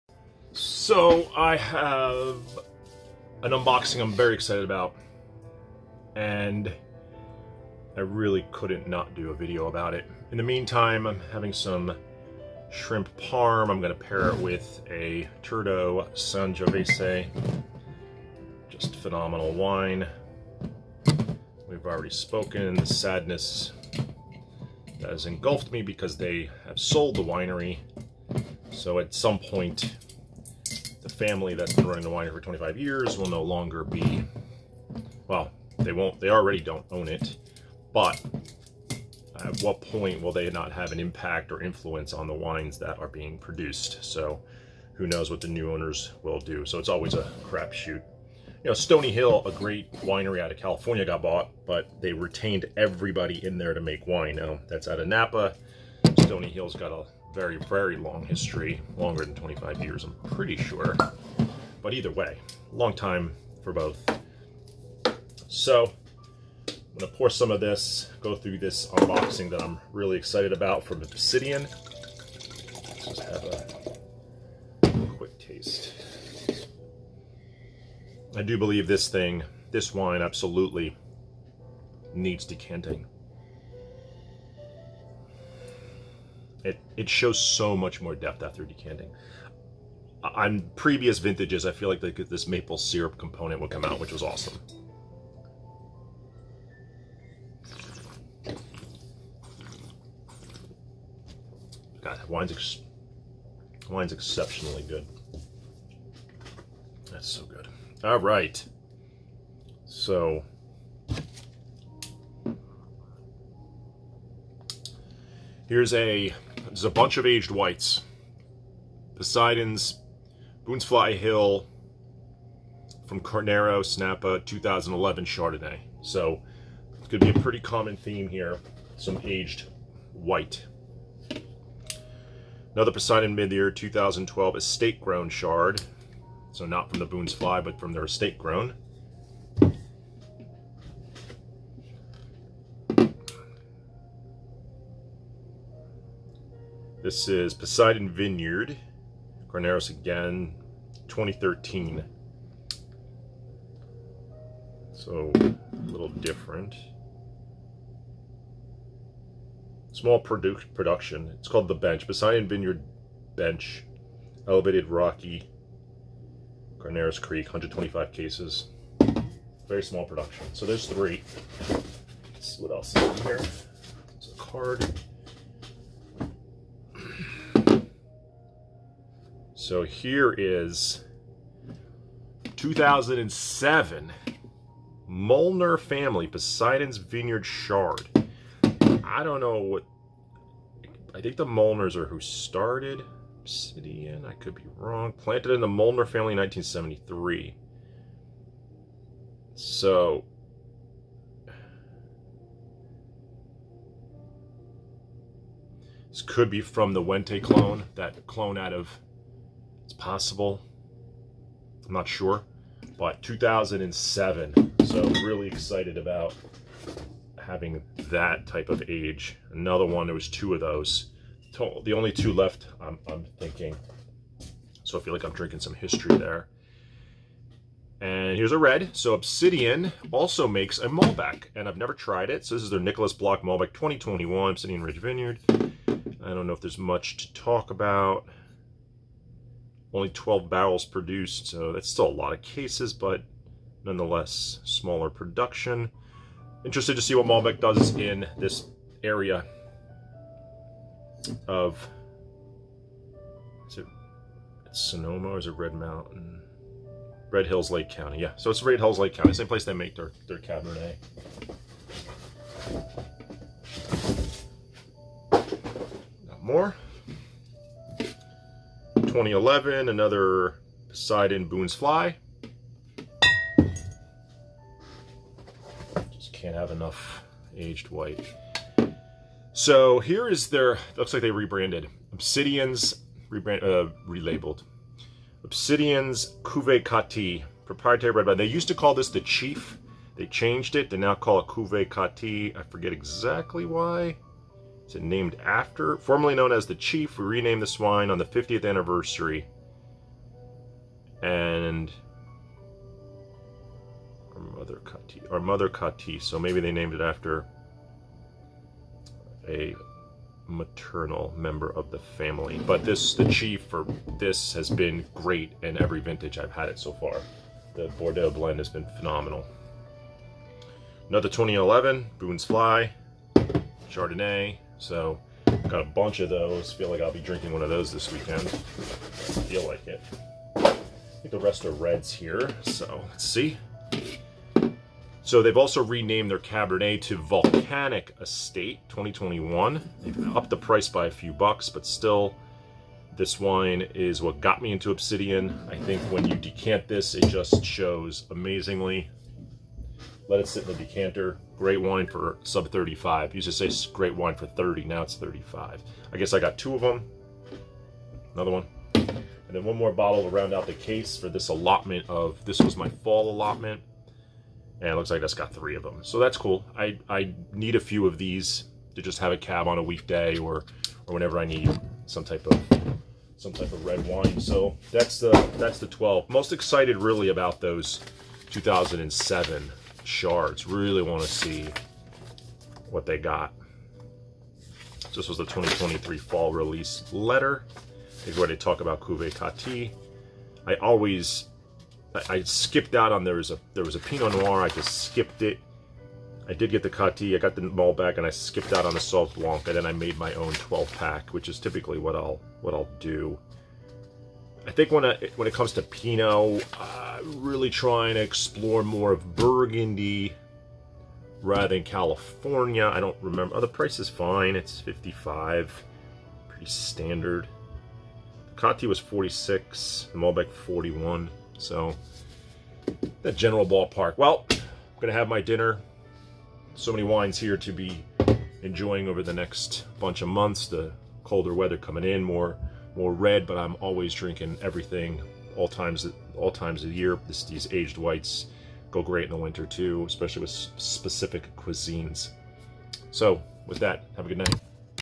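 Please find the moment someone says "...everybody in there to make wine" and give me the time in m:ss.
0:52.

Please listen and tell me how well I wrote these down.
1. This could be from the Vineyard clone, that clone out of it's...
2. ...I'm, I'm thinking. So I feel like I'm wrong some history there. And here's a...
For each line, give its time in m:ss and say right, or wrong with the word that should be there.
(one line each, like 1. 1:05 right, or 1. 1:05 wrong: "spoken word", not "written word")
1. 3:26 wrong: "Wente", not "Vineyard"
2. 3:42 wrong: "drinking", not "wrong".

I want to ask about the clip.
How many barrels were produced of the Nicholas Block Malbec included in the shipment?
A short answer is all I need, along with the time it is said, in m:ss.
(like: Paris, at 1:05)
12, at 4:00.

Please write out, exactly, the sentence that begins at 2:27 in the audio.
This is Poseidon Vineyard, Carneros again, 2013.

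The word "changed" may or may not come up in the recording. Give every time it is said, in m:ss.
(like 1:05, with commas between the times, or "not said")
4:50.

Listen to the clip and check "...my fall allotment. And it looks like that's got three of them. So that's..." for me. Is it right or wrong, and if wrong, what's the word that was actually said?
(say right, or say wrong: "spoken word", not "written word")
right.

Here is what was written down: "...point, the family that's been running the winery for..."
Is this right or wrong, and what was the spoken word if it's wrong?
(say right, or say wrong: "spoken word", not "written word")
right.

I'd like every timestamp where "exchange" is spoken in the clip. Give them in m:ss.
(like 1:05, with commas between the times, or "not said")
not said.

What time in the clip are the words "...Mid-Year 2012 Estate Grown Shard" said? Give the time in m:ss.
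2:13.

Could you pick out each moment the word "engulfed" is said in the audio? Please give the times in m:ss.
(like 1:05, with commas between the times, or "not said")
0:25.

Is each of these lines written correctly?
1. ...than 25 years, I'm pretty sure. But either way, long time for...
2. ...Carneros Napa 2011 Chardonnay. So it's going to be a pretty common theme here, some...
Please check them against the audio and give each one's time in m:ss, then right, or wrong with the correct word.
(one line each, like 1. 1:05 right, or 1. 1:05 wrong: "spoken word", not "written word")
1. 0:59 right
2. 2:03 right.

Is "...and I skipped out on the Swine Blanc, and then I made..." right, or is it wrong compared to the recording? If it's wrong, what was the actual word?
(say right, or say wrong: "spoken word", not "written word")
wrong: "Sauv", not "Swine".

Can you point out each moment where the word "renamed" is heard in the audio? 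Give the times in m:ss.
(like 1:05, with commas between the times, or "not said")
4:57, 5:35.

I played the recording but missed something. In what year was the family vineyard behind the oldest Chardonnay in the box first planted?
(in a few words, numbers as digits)
1973.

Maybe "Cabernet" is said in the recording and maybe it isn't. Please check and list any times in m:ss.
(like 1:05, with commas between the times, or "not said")
4:20, 5:36.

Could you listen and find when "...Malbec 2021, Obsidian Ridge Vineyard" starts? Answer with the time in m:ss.
3:53.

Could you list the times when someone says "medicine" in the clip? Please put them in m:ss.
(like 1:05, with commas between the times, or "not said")
not said.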